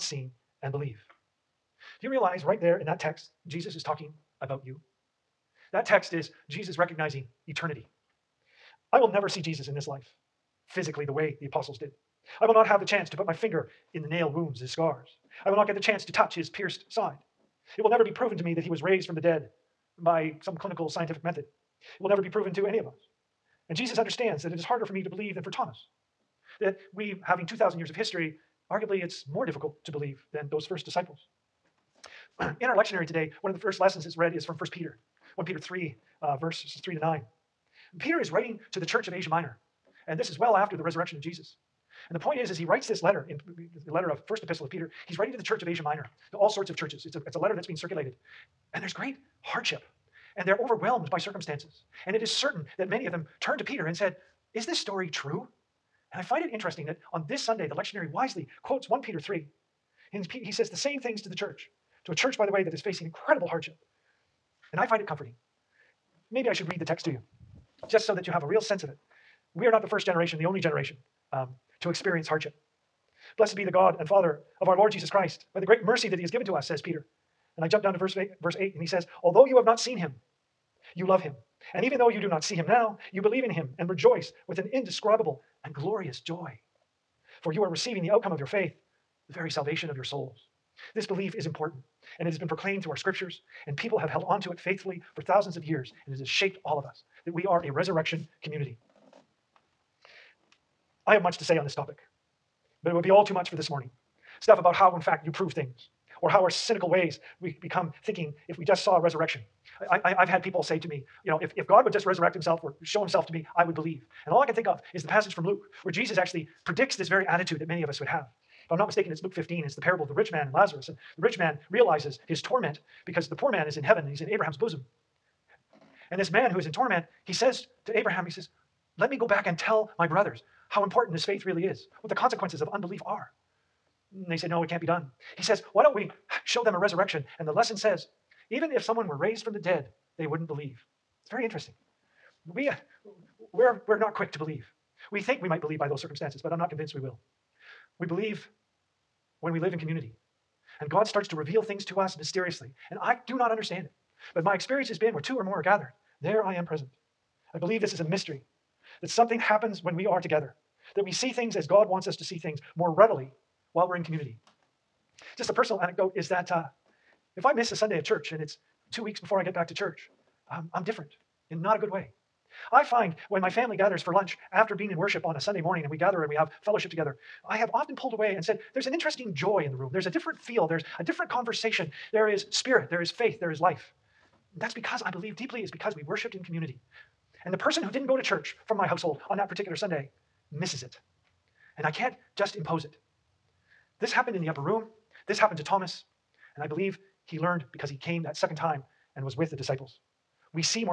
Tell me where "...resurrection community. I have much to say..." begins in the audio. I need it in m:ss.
1:37.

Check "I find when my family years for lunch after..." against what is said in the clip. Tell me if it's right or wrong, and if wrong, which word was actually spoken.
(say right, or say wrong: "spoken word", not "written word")
wrong: "gathers", not "years".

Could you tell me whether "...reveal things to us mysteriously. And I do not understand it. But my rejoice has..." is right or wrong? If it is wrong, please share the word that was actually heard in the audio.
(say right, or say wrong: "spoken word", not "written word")
wrong: "experience", not "rejoice".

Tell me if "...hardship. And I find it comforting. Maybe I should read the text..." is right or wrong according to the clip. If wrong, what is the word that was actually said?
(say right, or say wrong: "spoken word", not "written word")
right.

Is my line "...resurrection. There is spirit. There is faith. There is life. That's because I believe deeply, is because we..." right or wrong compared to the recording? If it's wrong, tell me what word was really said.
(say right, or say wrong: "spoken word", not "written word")
wrong: "conversation", not "resurrection".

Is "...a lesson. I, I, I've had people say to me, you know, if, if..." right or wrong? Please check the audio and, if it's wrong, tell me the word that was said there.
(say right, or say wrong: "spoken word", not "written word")
wrong: "resurrection", not "lesson".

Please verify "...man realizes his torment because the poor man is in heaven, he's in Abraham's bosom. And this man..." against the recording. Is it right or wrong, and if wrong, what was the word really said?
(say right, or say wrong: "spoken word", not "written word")
right.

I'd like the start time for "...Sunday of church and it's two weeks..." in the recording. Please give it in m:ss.
2:47.